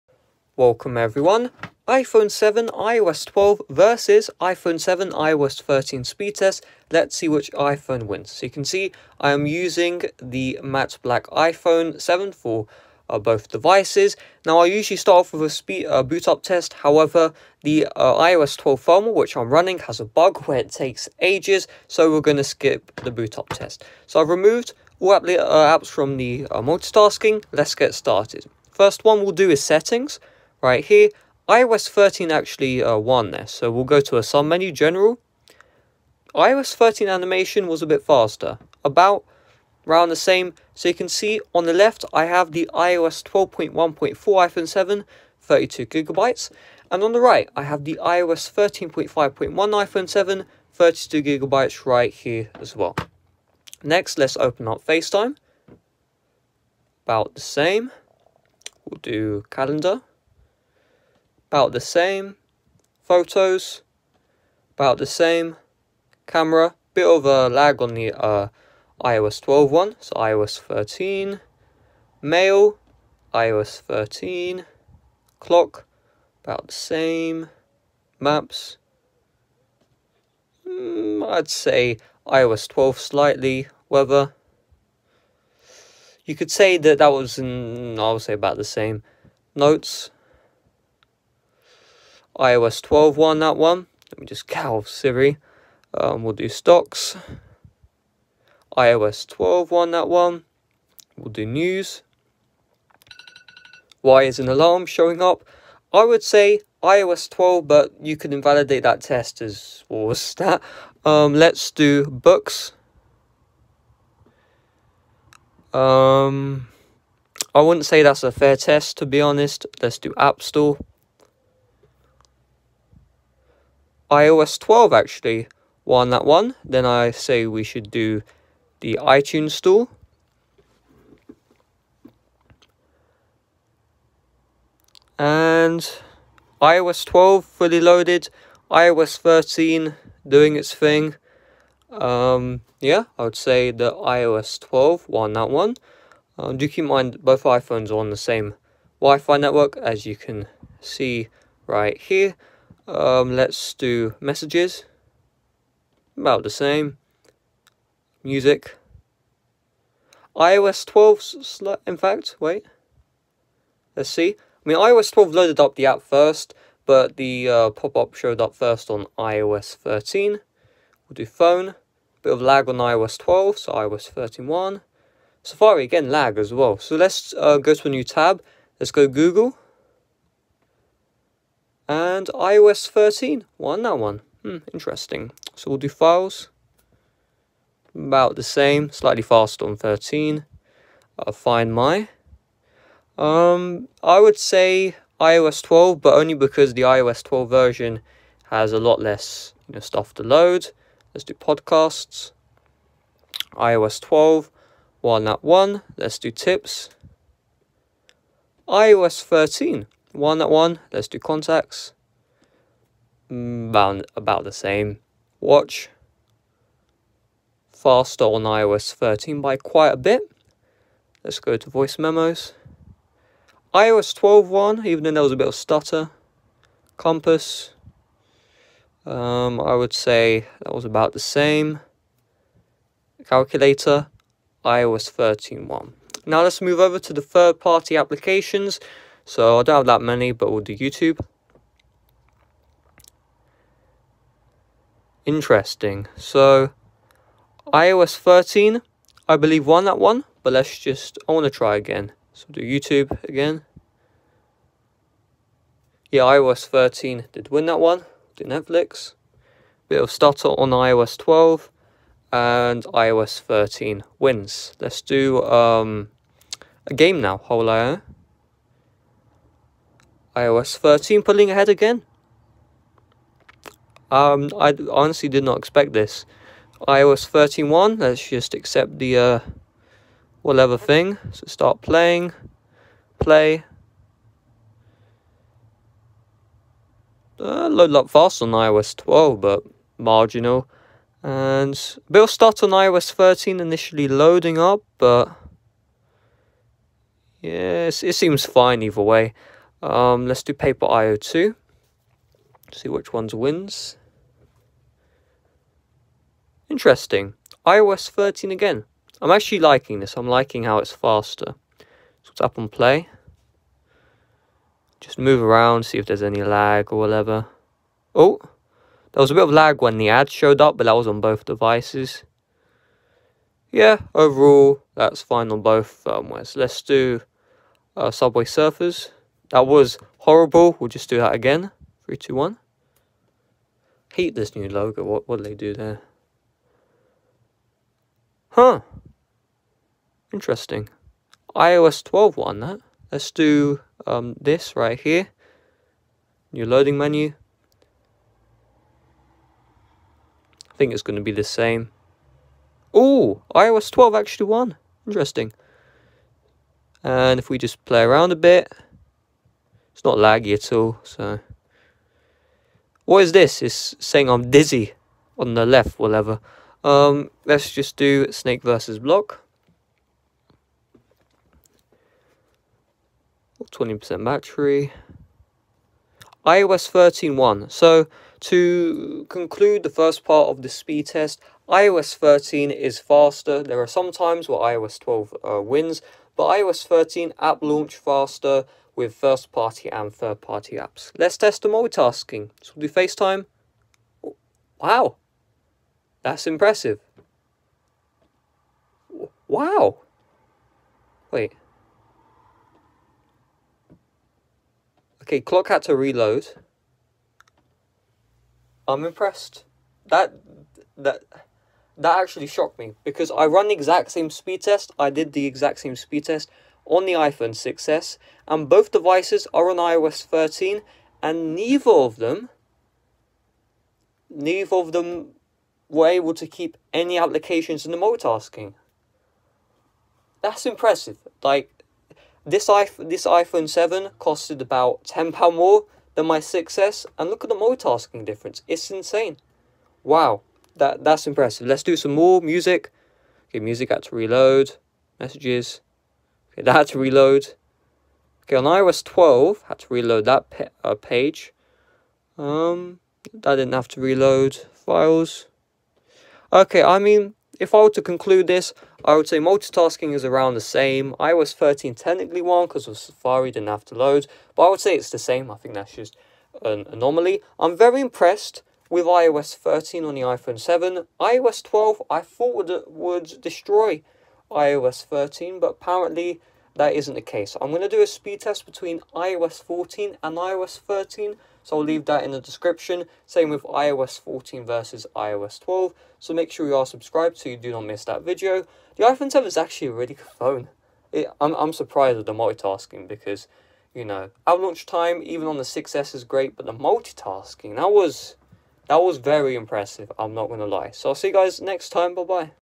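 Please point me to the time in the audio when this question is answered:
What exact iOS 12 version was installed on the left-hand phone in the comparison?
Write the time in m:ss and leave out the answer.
0:42.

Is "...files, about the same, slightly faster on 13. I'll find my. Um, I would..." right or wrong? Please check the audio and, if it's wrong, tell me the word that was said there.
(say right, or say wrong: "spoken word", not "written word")
right.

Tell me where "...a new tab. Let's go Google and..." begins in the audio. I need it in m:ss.
2:57.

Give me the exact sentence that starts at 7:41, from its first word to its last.
iOS 13 technically won because of Safari didn't have to load, but I would say it's the same.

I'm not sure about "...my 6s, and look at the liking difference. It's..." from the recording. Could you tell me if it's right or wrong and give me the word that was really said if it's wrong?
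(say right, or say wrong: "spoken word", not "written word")
wrong: "multitasking", not "liking".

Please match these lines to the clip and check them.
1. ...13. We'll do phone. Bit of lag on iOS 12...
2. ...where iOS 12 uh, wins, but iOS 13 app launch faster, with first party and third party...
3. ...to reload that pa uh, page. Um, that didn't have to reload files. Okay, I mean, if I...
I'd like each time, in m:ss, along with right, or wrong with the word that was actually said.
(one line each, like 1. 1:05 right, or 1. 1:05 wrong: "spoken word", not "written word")
1. 2:49 right
2. 6:24 right
3. 7:29 right.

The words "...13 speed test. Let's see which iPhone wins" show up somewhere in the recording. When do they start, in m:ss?
0:05.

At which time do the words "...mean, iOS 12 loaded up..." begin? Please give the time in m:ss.
2:44.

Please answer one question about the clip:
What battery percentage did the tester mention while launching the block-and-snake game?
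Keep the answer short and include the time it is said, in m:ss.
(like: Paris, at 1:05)
20%, at 6:13.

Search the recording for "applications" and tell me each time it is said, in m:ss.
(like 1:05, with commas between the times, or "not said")
3:57, 7:07.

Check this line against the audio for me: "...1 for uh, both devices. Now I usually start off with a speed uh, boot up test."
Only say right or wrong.
wrong.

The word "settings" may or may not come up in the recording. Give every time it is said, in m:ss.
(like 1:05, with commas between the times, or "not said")
0:29.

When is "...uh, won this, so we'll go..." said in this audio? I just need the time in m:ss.
0:32.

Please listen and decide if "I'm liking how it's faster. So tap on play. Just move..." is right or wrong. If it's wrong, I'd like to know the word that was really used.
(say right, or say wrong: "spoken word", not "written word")
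right.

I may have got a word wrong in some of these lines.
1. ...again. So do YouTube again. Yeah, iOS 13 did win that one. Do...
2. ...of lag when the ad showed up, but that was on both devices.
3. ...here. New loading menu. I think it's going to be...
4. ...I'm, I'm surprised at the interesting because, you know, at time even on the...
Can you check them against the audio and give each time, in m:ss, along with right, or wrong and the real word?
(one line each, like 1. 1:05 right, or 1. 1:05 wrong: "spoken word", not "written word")
1. 4:11 right
2. 5:19 right
3. 5:44 right
4. 8:11 wrong: "multitasking", not "interesting".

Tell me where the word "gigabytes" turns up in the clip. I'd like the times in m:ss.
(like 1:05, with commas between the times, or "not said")
0:45, 0:51.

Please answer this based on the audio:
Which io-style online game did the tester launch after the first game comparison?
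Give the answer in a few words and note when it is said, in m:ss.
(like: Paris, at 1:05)
Paper IO2, at 5:00.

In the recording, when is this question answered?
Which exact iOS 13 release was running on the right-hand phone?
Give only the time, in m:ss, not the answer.
0:47.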